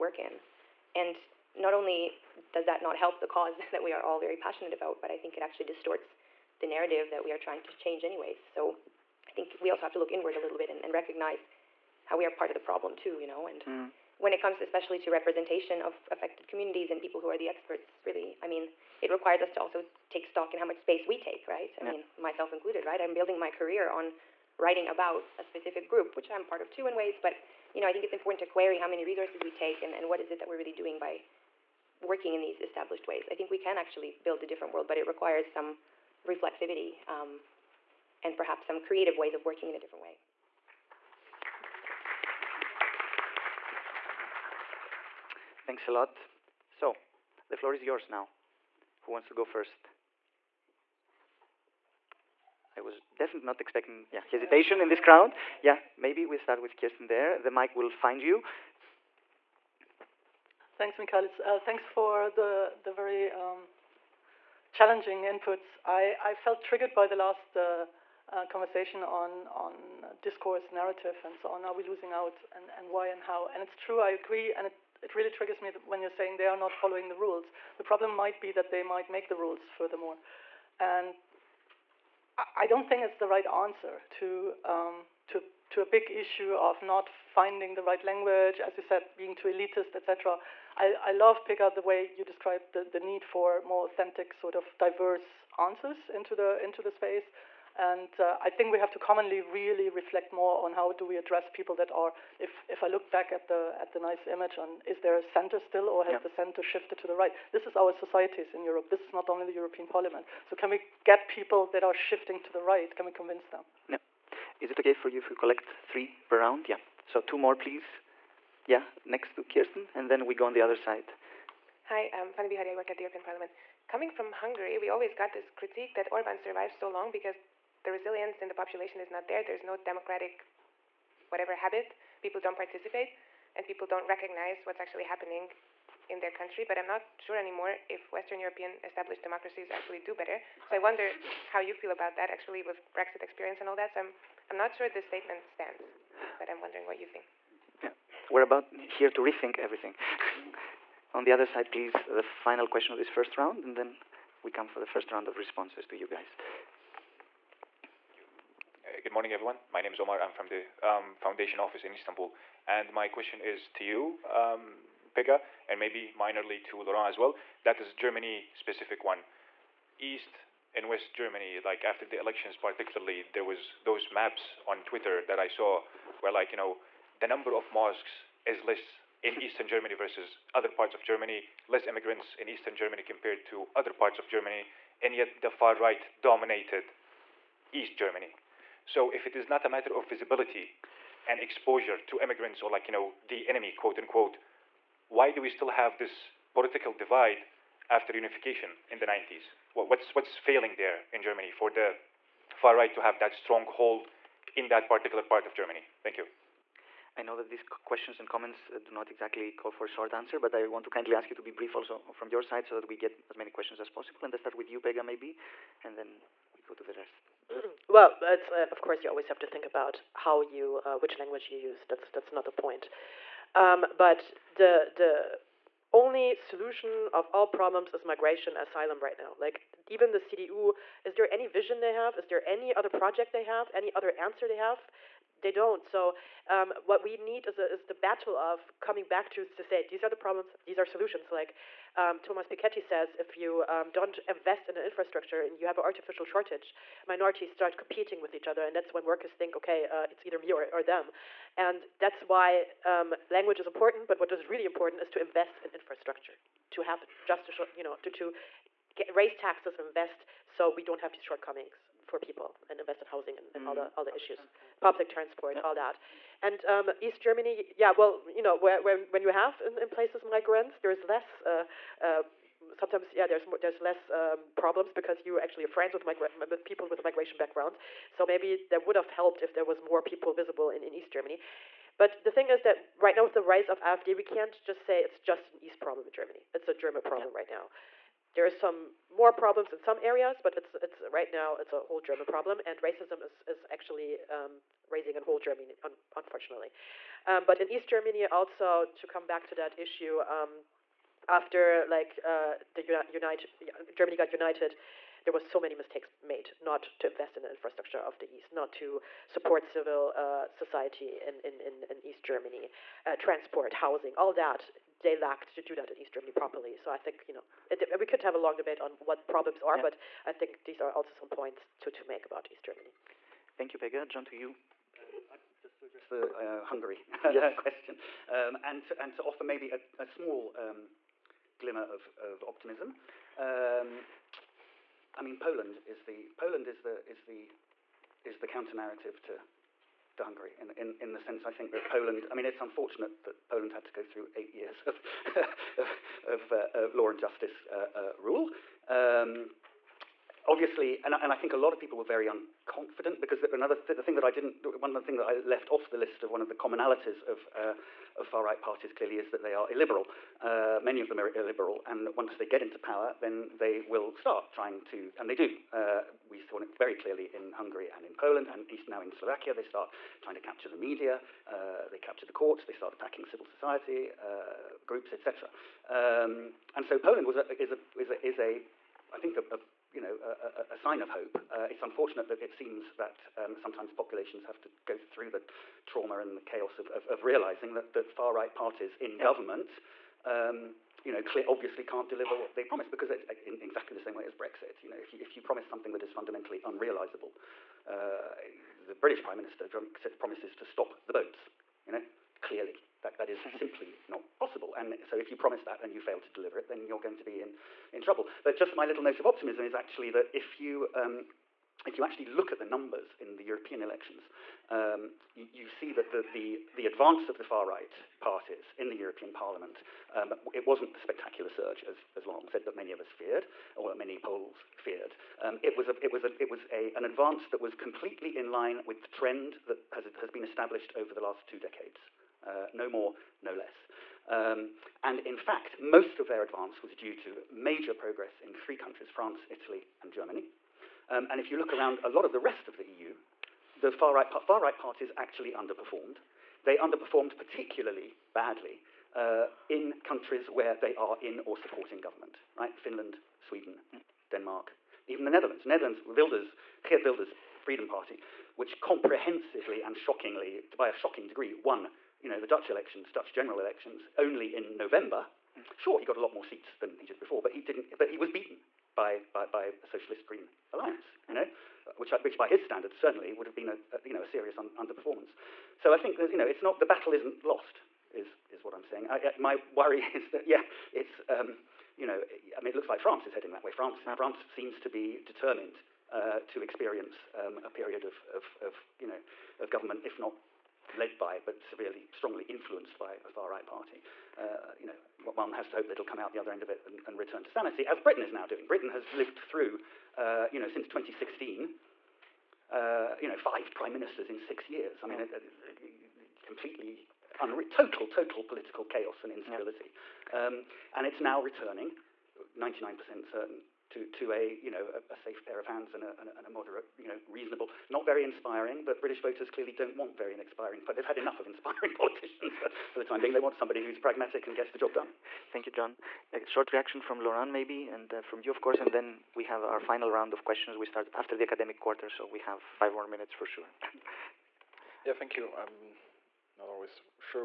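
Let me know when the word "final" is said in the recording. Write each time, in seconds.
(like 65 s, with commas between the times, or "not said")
152 s, 529 s.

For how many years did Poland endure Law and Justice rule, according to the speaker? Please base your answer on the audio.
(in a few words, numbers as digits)
8.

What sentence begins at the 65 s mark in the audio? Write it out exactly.
I, I felt triggered by the last uh, uh, conversation on on uh, discourse, narrative, and so on.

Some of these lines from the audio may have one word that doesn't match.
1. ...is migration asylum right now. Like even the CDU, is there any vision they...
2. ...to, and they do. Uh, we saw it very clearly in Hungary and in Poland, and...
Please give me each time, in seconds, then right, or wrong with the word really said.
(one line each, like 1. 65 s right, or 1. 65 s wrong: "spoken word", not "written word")
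1. 227 s right
2. 364 s right.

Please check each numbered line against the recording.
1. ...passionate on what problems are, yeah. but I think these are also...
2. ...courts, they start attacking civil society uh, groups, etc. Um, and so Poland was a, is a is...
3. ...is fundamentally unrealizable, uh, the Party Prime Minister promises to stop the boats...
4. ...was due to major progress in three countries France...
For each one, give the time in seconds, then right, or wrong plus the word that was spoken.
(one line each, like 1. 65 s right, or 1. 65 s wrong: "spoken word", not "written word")
1. 318 s wrong: "debate", not "passionate"
2. 372 s right
3. 396 s wrong: "British", not "Party"
4. 436 s right.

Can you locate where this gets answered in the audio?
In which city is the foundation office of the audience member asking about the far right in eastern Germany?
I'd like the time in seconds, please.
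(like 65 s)
161 s.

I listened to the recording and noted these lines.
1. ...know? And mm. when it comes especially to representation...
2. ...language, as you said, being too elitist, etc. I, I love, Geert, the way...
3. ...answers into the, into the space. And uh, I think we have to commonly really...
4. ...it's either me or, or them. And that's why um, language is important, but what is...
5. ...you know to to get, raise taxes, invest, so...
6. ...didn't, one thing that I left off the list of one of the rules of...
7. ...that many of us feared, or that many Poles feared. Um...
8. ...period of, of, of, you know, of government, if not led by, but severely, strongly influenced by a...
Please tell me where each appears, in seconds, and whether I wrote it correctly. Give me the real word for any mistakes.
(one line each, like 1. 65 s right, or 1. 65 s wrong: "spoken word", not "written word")
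1. 13 s right
2. 88 s wrong: "Pegah", not "Geert"
3. 95 s right
4. 250 s right
5. 257 s right
6. 354 s wrong: "commonalities", not "rules"
7. 422 s right
8. 487 s right.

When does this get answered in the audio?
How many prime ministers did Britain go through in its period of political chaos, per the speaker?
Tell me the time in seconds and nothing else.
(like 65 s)
503 s.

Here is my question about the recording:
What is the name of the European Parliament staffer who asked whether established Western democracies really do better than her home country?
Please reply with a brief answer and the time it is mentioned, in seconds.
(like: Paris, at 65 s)
Fanny Bihari, at 122 s.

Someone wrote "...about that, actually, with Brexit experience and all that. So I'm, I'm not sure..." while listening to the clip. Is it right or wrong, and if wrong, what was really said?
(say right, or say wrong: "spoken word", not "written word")
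right.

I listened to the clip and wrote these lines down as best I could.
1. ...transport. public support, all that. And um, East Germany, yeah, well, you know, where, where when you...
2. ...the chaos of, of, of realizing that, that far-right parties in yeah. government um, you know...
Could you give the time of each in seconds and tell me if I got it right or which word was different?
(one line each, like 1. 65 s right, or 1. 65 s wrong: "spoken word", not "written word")
1. 264 s wrong: "transport", not "support"
2. 386 s right.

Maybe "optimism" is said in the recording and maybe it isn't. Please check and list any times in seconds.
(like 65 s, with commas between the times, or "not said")
332 s, 409 s.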